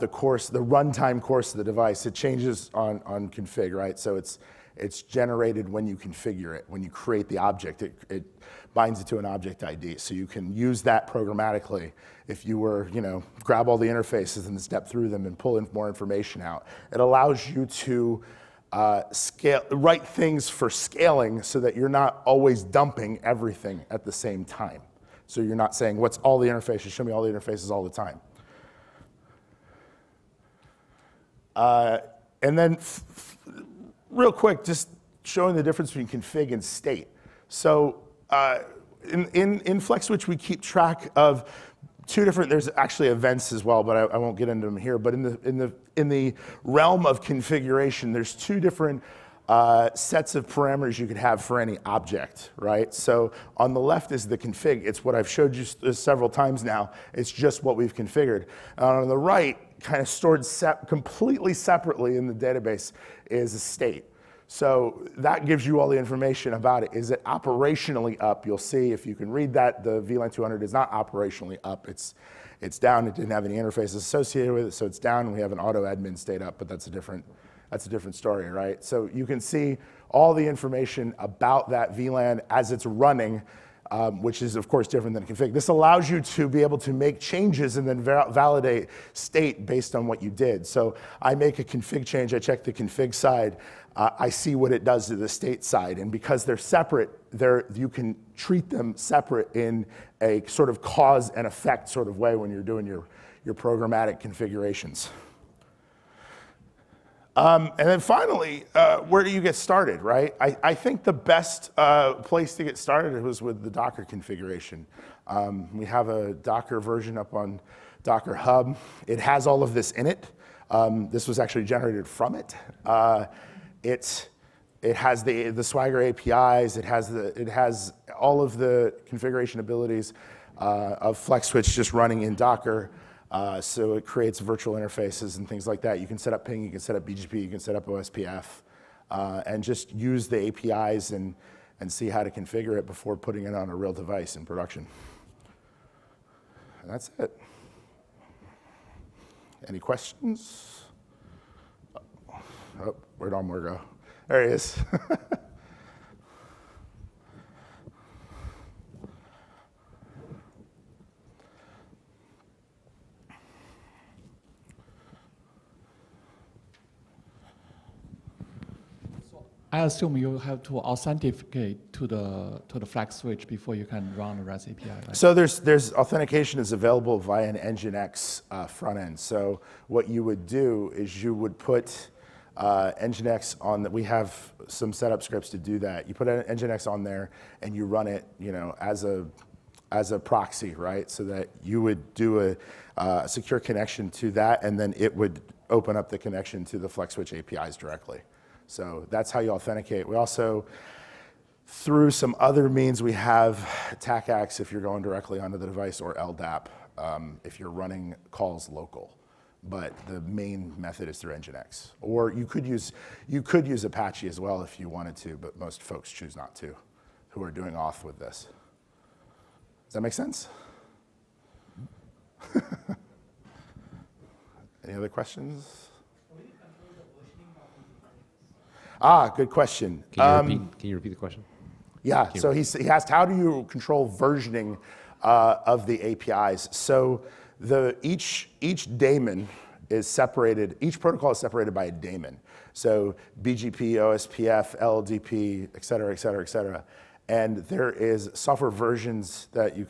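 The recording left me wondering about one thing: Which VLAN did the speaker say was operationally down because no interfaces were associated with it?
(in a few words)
VLAN 200.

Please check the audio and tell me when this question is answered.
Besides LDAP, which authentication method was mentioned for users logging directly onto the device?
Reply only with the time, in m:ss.
3:24.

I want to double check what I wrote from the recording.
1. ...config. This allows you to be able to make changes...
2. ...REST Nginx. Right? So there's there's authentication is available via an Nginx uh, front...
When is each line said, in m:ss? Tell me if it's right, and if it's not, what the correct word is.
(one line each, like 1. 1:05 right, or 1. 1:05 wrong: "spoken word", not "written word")
1. 1:25 right
2. 2:54 wrong: "API", not "Nginx".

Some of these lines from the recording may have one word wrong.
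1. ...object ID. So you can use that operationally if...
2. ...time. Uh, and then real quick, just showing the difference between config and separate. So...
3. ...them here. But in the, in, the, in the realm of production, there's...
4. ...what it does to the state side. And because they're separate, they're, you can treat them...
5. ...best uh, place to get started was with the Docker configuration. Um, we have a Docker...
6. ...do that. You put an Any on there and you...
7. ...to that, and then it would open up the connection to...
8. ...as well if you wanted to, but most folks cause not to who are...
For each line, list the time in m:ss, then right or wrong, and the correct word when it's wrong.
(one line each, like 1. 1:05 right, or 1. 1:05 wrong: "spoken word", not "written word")
1. 0:09 wrong: "programmatically", not "operationally"
2. 0:27 wrong: "state", not "separate"
3. 0:44 wrong: "configuration", not "production"
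4. 1:34 right
5. 1:51 right
6. 3:05 wrong: "Nginx", not "Any"
7. 3:14 right
8. 3:34 wrong: "choose", not "cause".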